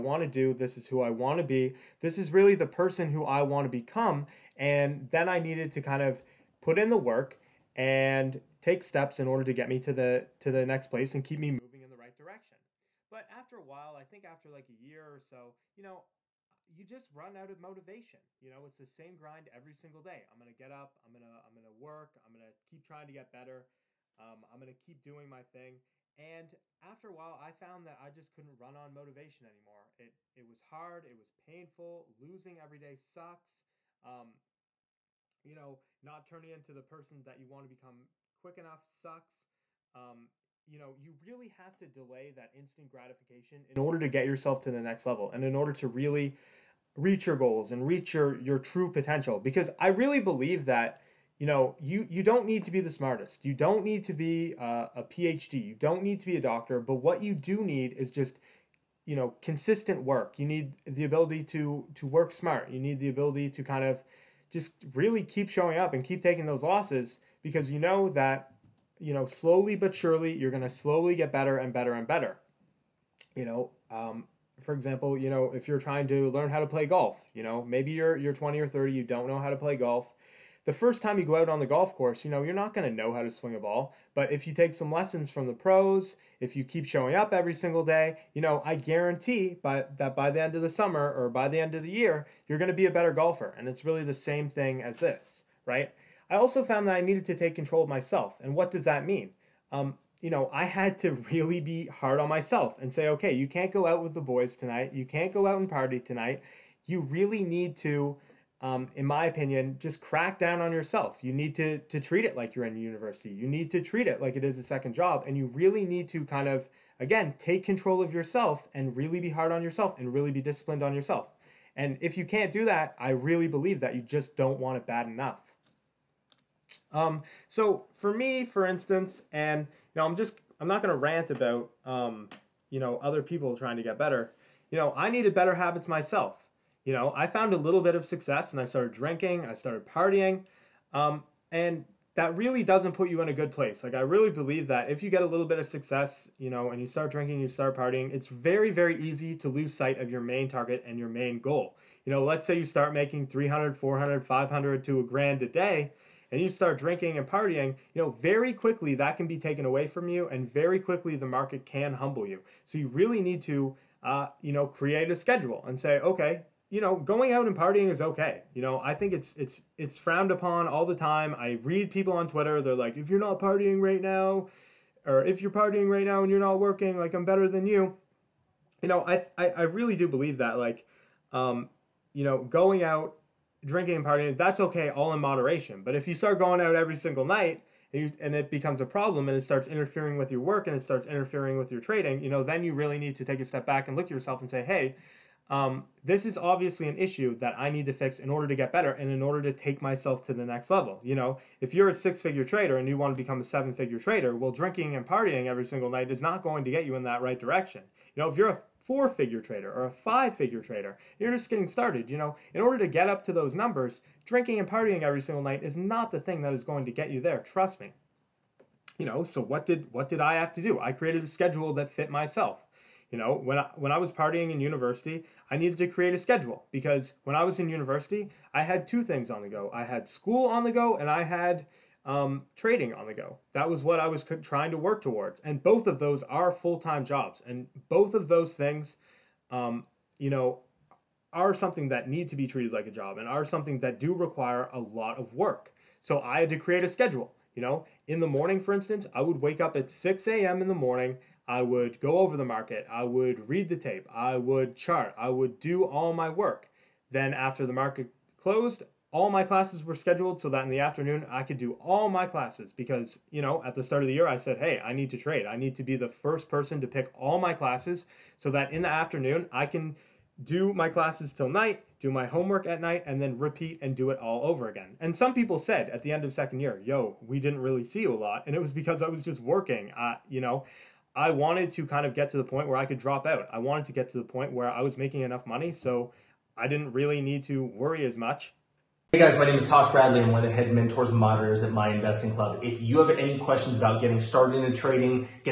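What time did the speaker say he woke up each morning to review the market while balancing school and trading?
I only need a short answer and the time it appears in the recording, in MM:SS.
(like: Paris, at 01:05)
6 a.m., at 04:09.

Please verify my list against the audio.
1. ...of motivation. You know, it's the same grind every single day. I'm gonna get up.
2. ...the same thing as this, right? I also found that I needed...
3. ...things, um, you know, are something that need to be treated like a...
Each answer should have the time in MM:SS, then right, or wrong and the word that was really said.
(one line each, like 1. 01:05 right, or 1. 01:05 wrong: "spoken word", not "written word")
1. 00:17 right
2. 01:34 right
3. 03:58 right.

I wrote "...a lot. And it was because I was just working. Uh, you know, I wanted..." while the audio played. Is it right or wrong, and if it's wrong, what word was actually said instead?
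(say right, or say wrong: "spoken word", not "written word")
right.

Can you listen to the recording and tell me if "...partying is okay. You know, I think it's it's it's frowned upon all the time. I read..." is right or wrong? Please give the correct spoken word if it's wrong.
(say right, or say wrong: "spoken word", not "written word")
right.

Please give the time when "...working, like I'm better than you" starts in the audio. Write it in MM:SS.
02:56.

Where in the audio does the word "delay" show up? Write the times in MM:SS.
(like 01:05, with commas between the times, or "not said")
00:41.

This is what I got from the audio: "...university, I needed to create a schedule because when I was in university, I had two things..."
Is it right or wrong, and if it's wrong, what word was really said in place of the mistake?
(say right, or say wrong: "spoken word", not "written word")
right.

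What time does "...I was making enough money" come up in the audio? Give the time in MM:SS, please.
04:44.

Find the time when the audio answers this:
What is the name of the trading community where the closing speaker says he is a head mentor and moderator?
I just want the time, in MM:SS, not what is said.
04:51.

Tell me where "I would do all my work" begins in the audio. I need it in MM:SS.
04:15.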